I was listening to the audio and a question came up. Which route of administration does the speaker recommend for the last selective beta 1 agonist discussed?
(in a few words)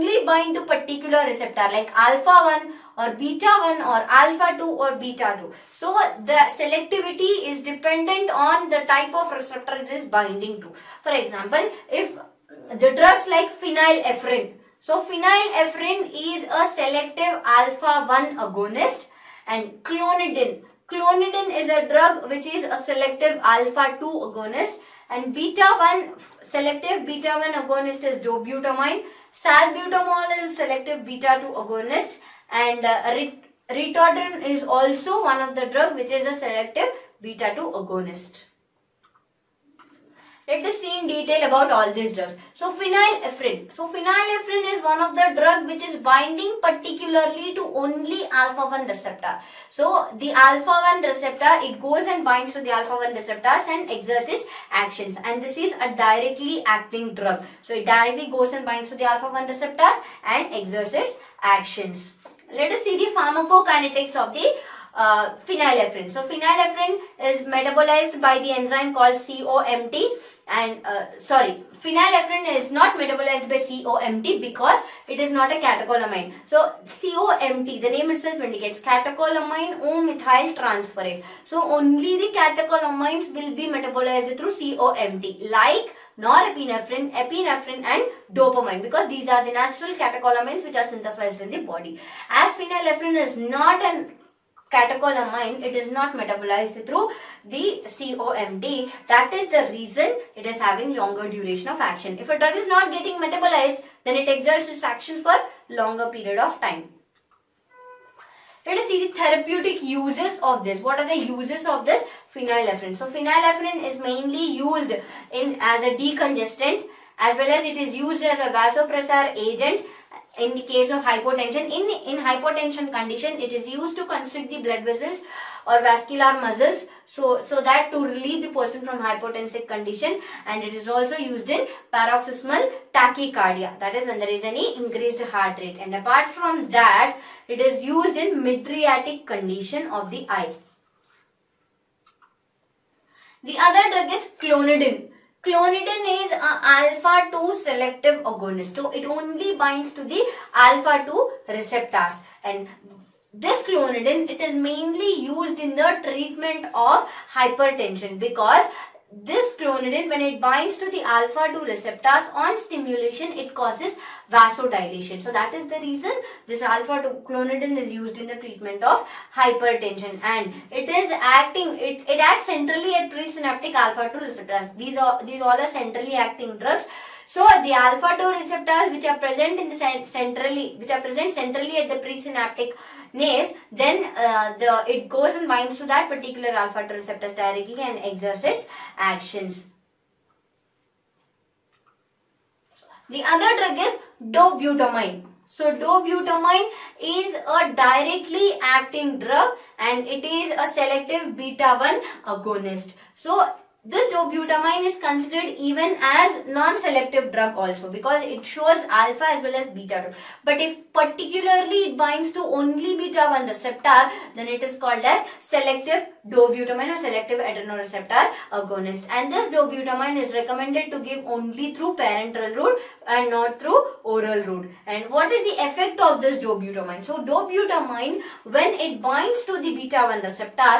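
Parenteral.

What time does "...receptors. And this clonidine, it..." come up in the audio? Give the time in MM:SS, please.
02:31.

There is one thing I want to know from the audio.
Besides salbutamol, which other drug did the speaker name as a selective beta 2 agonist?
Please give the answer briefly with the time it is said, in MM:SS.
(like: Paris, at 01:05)
Ritodrine, at 00:33.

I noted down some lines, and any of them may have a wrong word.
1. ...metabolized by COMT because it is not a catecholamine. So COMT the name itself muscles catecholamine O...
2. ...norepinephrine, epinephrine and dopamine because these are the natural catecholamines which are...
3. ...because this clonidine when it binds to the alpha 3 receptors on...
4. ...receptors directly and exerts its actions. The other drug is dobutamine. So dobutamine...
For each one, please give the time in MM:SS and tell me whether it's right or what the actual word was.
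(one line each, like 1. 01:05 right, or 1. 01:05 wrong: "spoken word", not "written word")
1. 01:12 wrong: "indicates", not "muscles"
2. 01:26 right
3. 02:38 wrong: "2", not "3"
4. 03:06 right.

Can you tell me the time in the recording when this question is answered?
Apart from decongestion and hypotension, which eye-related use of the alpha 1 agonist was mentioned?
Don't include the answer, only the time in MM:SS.
02:18.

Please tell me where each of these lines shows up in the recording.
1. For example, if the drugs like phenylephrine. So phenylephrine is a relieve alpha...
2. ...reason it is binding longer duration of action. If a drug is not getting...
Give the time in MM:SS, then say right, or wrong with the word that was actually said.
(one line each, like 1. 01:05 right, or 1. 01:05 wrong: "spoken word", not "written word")
1. 00:11 wrong: "selective", not "relieve"
2. 01:39 wrong: "having", not "binding".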